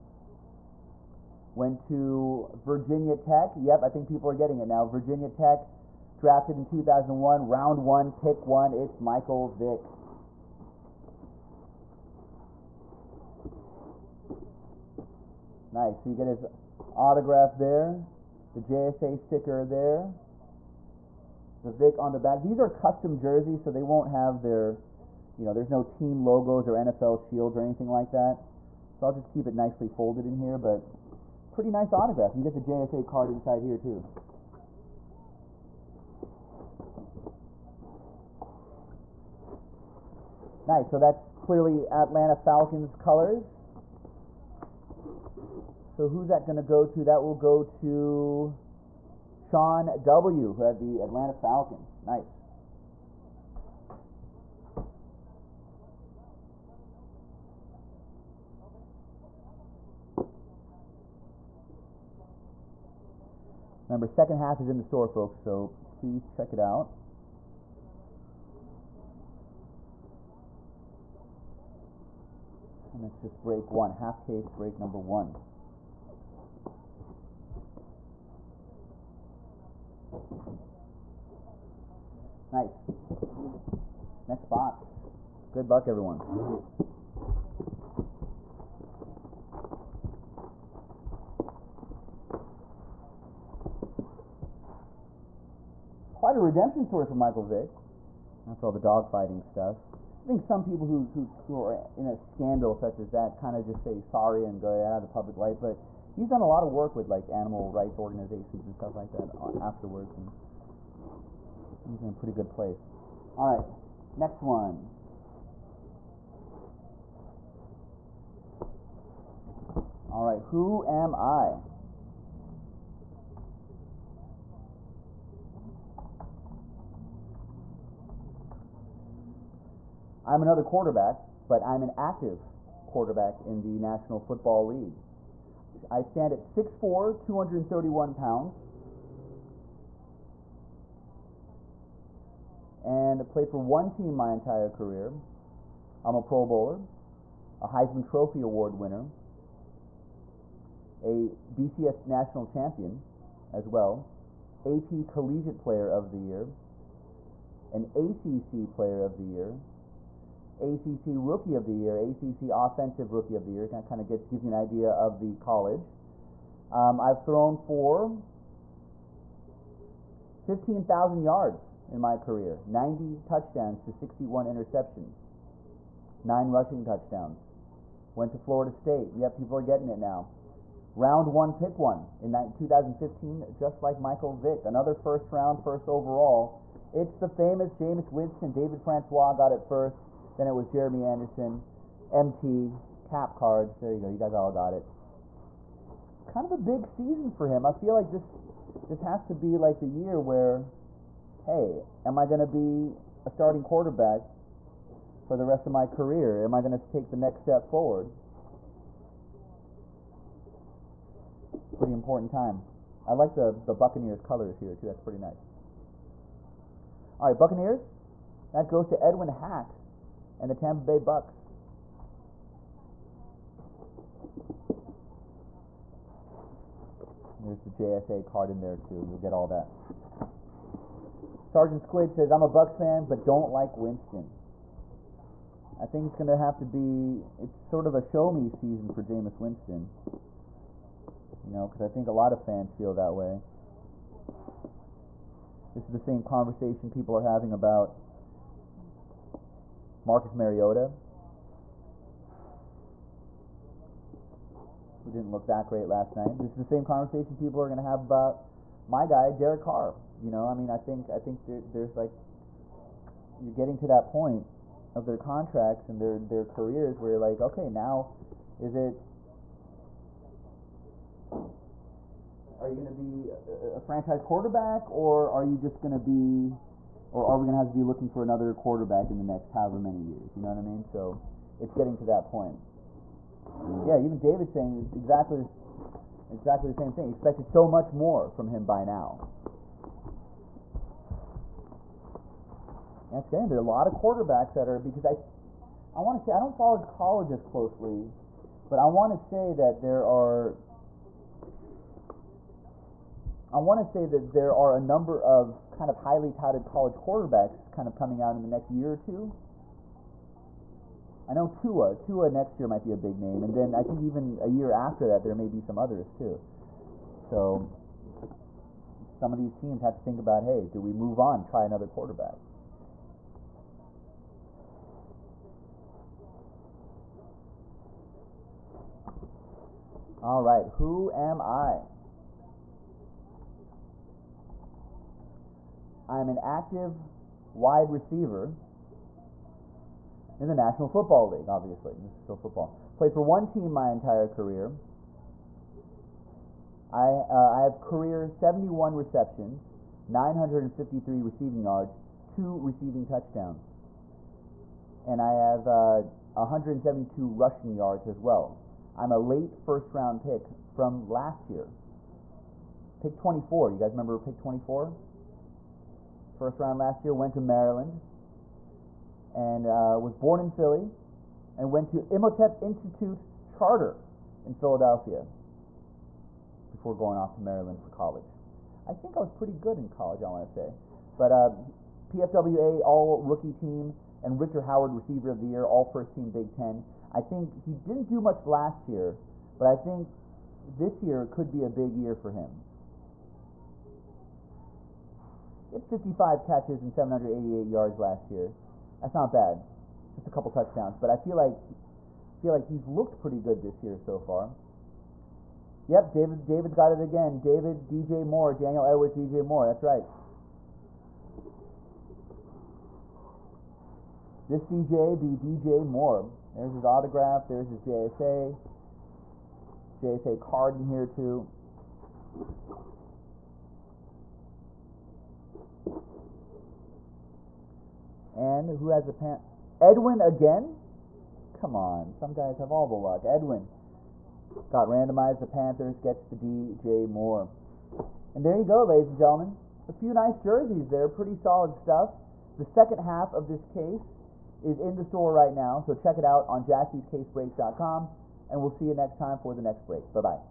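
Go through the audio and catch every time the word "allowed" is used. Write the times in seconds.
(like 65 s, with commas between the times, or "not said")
not said.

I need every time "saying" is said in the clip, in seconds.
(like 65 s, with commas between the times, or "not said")
284 s.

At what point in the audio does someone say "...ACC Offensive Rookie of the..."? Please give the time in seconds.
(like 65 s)
161 s.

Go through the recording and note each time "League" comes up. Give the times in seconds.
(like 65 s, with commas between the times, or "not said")
134 s, 341 s.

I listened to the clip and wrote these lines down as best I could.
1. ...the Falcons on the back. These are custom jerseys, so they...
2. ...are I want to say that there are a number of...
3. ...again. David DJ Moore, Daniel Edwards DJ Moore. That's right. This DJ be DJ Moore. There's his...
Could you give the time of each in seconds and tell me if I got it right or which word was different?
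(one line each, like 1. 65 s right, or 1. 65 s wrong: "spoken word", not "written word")
1. 21 s wrong: "Vick", not "Falcons"
2. 300 s right
3. 407 s right.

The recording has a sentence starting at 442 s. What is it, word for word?
The second half of this case is in the store right now, so check it out on jaspyscasebreaks.com.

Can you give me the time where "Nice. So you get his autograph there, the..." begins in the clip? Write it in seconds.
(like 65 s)
15 s.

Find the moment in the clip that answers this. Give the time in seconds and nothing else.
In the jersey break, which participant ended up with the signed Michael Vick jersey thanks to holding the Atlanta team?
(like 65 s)
49 s.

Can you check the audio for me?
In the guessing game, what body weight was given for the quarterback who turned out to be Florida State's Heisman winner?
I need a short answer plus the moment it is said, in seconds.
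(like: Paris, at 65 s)
231 pounds, at 137 s.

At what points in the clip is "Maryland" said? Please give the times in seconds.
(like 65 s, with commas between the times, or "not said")
367 s, 377 s.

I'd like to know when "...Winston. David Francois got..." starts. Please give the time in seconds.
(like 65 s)
188 s.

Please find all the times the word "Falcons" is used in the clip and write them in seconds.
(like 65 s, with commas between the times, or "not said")
42 s, 51 s.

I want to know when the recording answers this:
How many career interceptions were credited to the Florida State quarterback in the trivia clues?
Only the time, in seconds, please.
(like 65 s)
173 s.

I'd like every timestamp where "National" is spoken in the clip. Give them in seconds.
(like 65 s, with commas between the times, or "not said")
133 s, 152 s, 340 s.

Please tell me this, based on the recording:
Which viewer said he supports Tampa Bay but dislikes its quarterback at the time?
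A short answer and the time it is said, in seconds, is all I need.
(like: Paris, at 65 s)
Sergeant Squid, at 231 s.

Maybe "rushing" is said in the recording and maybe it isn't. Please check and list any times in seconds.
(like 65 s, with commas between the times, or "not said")
176 s, 357 s.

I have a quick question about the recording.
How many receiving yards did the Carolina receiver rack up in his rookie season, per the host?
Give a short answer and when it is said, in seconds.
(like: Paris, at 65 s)
788, at 396 s.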